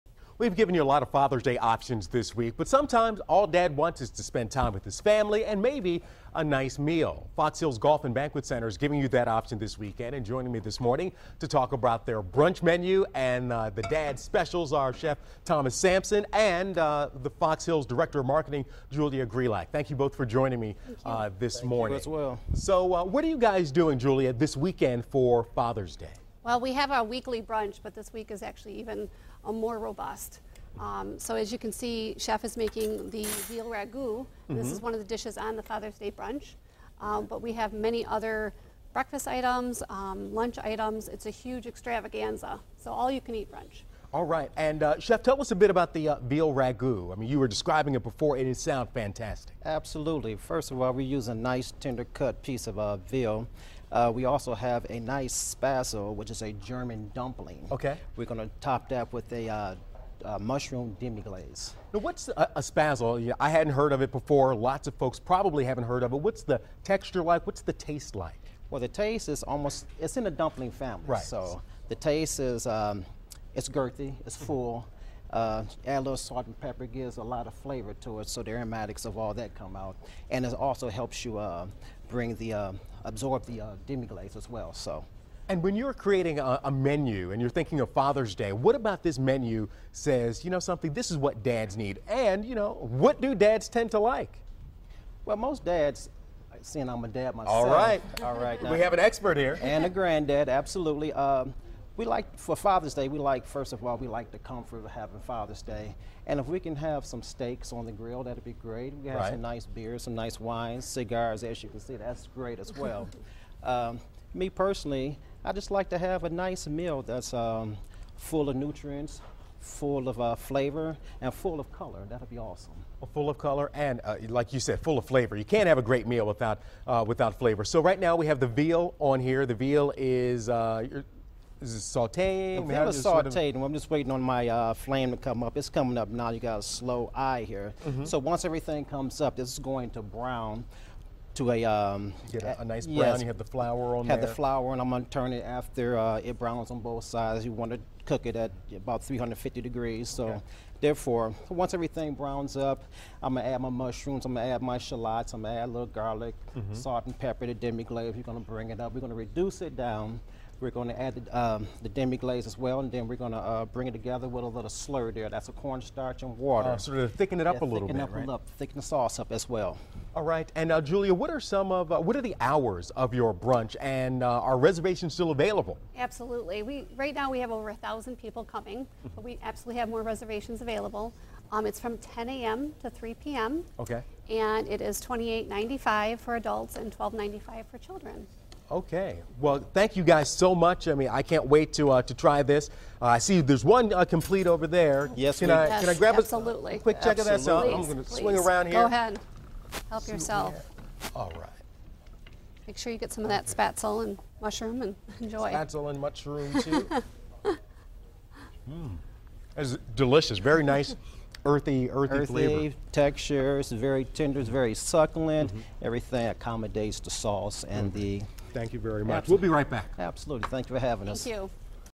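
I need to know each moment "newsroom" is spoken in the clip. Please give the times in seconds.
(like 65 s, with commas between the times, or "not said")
not said.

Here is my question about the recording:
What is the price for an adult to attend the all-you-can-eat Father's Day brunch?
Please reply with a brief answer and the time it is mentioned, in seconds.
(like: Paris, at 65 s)
$28.95, at 185 s.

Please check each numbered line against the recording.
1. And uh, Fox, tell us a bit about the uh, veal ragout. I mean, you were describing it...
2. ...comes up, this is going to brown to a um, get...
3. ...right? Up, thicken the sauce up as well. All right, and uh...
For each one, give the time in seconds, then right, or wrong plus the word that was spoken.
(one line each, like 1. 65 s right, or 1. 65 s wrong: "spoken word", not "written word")
1. 44 s wrong: "Chef", not "Fox"
2. 138 s right
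3. 168 s right.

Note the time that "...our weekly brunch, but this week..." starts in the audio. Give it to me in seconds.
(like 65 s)
26 s.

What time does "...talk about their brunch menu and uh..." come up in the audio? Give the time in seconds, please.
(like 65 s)
11 s.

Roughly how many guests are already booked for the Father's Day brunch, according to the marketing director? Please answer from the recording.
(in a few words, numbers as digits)
Over 1,000.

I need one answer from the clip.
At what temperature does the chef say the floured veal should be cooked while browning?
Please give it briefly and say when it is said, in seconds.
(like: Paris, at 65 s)
350 degrees, at 149 s.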